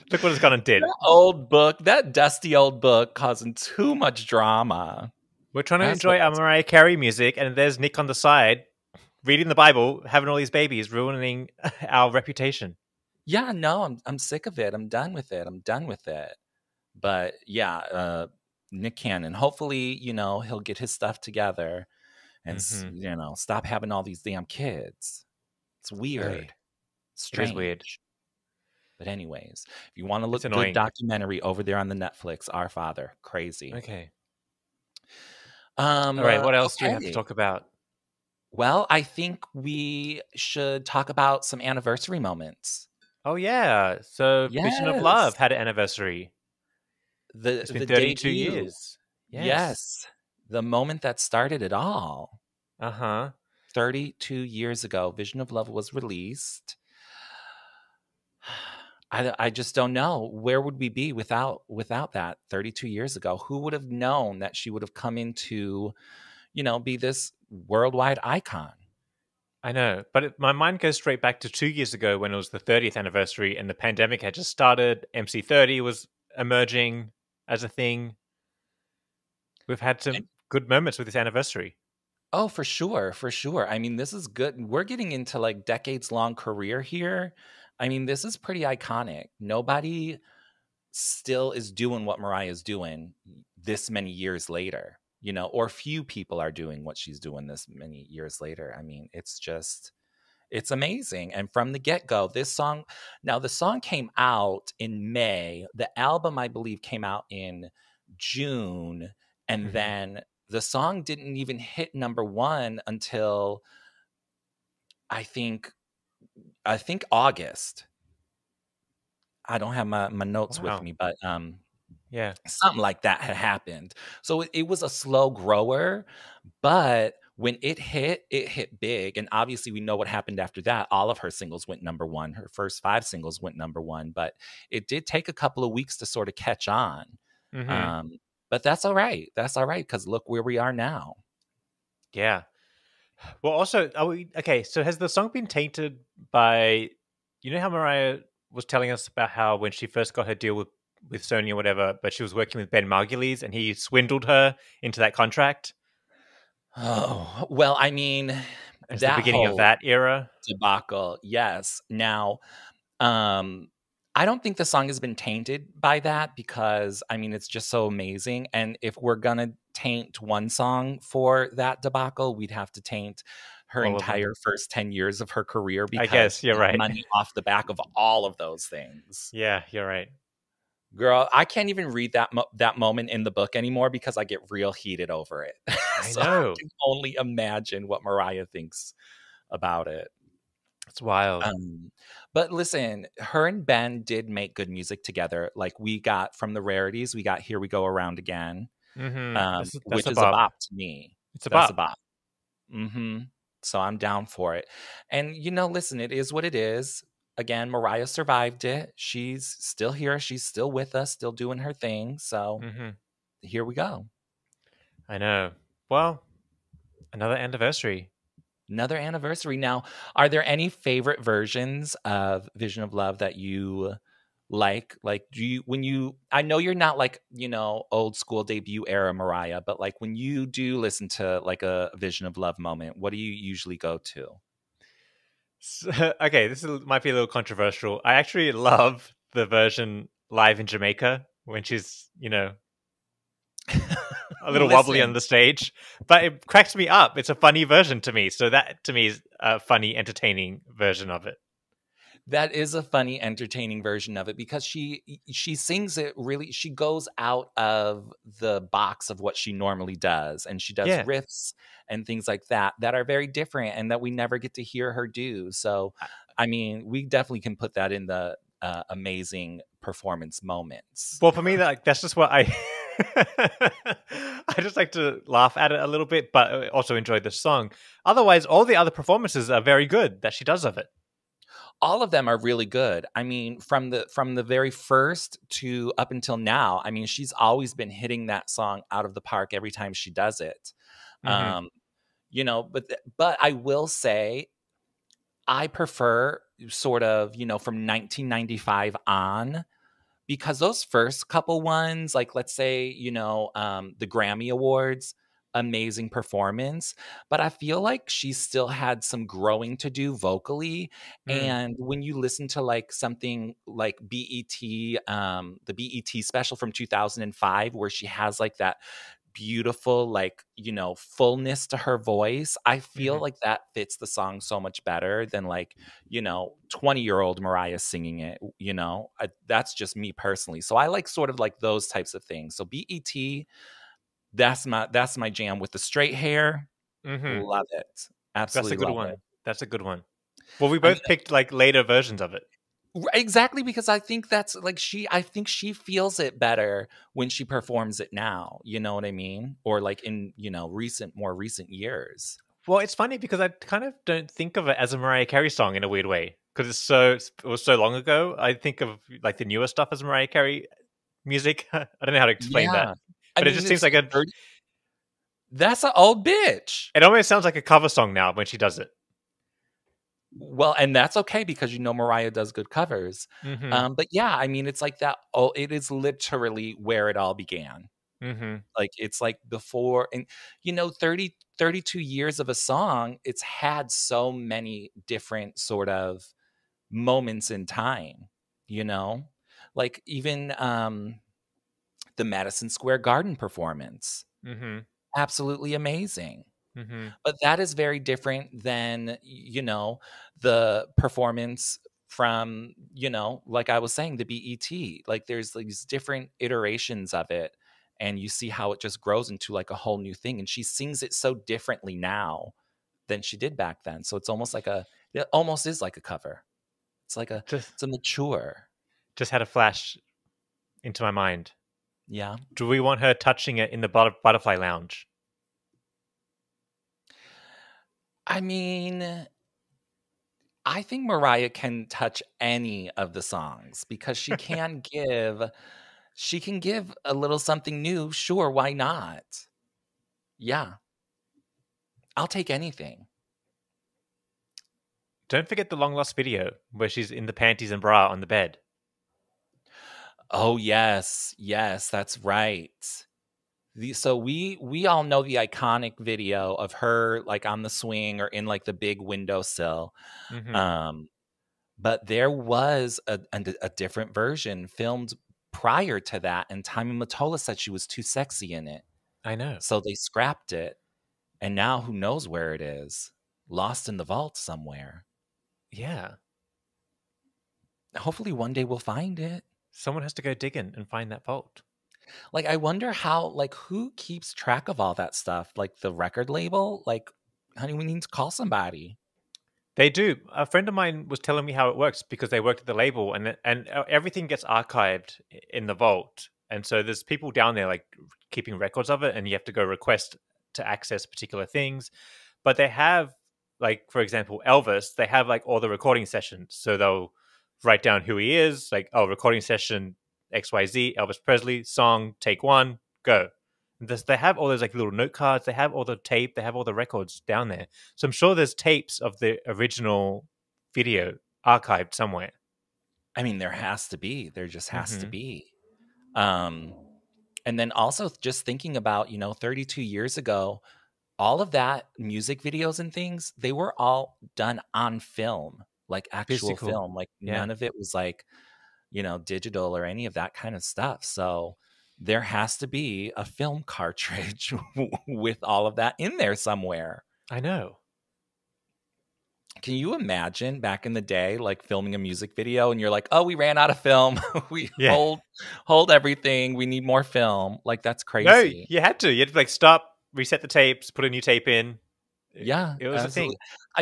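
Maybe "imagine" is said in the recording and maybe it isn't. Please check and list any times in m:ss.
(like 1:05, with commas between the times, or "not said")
3:07, 9:09.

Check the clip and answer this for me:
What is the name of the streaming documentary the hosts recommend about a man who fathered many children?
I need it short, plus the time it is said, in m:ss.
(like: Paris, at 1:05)
Our Father, at 0:32.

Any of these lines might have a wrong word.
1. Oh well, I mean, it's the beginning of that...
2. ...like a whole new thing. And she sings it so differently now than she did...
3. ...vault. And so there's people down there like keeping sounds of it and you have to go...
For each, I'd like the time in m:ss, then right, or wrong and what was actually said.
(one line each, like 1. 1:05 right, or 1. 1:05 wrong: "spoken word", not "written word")
1. 2:36 right
2. 6:49 right
3. 8:15 wrong: "records", not "sounds".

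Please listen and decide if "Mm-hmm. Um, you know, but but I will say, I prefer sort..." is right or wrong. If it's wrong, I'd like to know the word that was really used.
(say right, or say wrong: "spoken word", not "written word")
right.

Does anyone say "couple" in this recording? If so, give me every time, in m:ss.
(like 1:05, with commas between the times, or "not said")
2:15, 5:01.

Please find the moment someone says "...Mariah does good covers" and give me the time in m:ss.
6:11.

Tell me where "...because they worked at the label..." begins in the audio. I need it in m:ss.
8:12.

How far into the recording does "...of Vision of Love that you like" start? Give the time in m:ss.
3:42.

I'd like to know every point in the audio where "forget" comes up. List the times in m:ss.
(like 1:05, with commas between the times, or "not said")
7:25.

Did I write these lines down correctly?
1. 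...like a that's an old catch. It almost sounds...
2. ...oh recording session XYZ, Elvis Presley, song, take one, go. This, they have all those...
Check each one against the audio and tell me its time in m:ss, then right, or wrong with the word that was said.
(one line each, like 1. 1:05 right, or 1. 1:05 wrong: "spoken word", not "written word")
1. 6:03 wrong: "bitch", not "catch"
2. 8:28 right.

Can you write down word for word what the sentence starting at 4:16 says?
She goes out of the box of what she normally does, and she does yeah.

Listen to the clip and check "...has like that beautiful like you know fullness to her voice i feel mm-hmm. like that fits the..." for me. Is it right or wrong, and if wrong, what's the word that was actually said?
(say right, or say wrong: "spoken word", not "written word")
right.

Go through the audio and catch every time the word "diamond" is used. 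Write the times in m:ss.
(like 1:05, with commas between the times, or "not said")
not said.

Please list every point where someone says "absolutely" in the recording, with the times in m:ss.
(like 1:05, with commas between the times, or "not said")
5:38, 6:35, 9:23.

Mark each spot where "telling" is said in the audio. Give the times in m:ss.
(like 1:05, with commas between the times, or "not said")
2:28, 8:11.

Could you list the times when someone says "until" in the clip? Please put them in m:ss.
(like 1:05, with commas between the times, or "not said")
1:52, 4:46.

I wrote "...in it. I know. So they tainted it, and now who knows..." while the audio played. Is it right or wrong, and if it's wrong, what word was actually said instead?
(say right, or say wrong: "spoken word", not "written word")
wrong: "scrapped", not "tainted".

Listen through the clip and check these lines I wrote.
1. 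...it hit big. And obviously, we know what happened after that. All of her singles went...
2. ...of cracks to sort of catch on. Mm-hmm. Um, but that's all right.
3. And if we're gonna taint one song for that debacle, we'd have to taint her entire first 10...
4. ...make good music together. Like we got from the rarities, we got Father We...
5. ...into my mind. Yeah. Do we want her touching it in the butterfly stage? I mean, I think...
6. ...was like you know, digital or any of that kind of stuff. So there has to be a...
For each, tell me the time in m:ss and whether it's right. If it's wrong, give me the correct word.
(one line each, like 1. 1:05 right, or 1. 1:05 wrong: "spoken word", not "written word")
1. 2:08 right
2. 2:15 wrong: "weeks", not "cracks"
3. 2:48 right
4. 3:14 wrong: "Here", not "Father"
5. 7:00 wrong: "lounge", not "stage"
6. 8:57 right.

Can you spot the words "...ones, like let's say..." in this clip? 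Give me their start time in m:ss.
5:01.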